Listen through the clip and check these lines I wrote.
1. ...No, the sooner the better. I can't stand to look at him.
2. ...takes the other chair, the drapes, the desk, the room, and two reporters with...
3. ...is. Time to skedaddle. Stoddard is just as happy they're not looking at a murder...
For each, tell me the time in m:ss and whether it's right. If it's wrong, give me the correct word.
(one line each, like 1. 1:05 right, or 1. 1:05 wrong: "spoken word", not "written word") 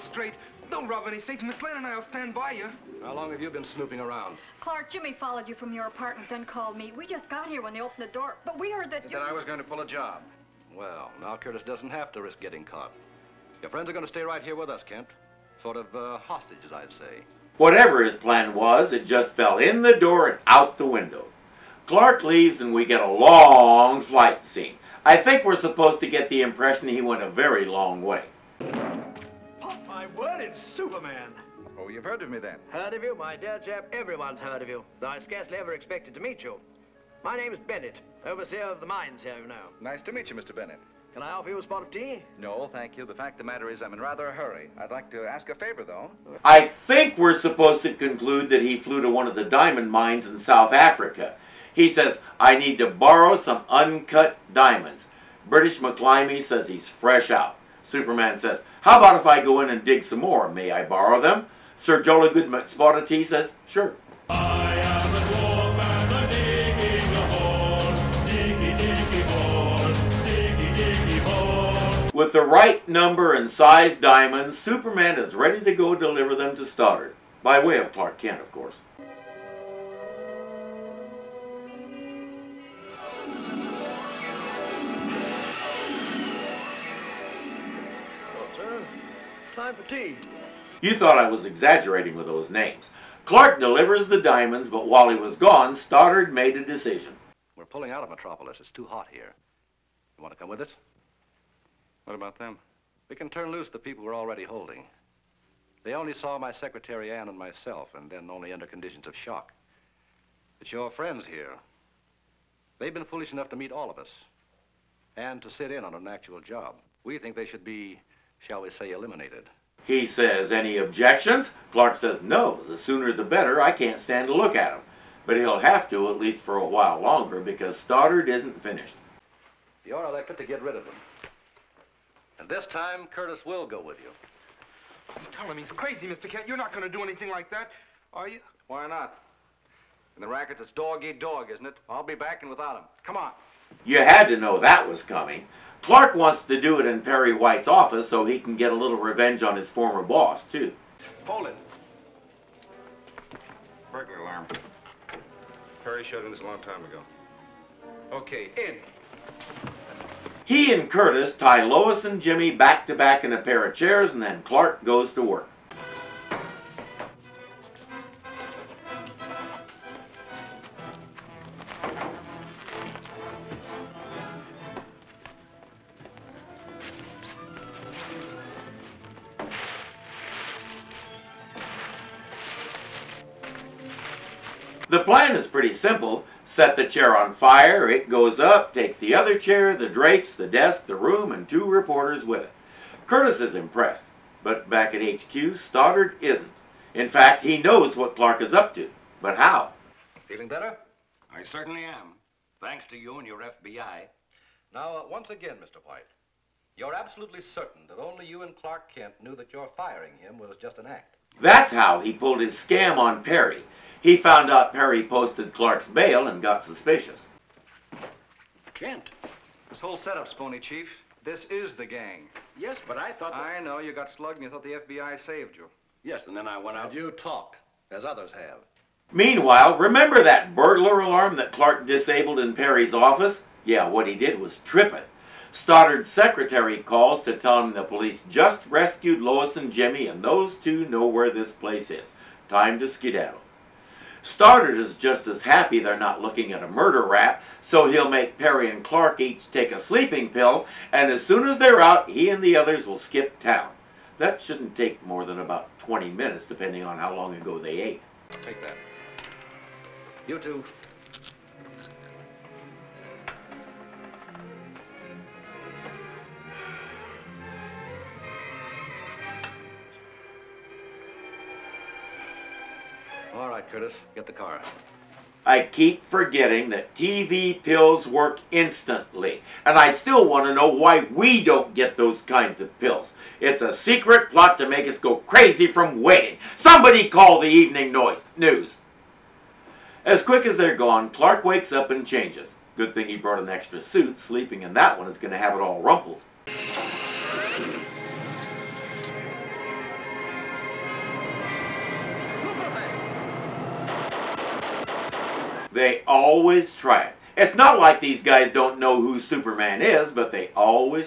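1. 2:02 right
2. 3:08 right
3. 4:01 right.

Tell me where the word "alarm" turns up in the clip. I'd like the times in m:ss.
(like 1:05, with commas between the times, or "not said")
2:34, 3:51.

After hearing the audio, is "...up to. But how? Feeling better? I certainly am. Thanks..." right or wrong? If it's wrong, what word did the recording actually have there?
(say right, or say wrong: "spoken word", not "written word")
right.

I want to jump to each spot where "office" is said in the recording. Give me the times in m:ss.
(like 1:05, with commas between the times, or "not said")
2:27, 3:52.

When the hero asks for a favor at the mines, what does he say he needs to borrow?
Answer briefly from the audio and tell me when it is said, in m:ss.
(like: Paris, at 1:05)
uncut diamonds, at 0:53.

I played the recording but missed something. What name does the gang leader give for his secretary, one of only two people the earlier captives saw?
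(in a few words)
Ann.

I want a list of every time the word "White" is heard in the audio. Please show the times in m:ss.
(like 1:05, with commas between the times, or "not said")
2:27, 3:25.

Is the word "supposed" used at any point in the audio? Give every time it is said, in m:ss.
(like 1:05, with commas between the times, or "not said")
0:25, 0:47.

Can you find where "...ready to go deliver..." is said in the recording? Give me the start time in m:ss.
1:15.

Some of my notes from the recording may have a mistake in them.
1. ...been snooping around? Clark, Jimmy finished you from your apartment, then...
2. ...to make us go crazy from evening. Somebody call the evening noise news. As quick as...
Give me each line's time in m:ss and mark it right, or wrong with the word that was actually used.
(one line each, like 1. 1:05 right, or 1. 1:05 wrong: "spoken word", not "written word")
1. 0:03 wrong: "followed", not "finished"
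2. 4:44 wrong: "waiting", not "evening".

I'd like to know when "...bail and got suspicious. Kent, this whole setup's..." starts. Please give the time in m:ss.
3:35.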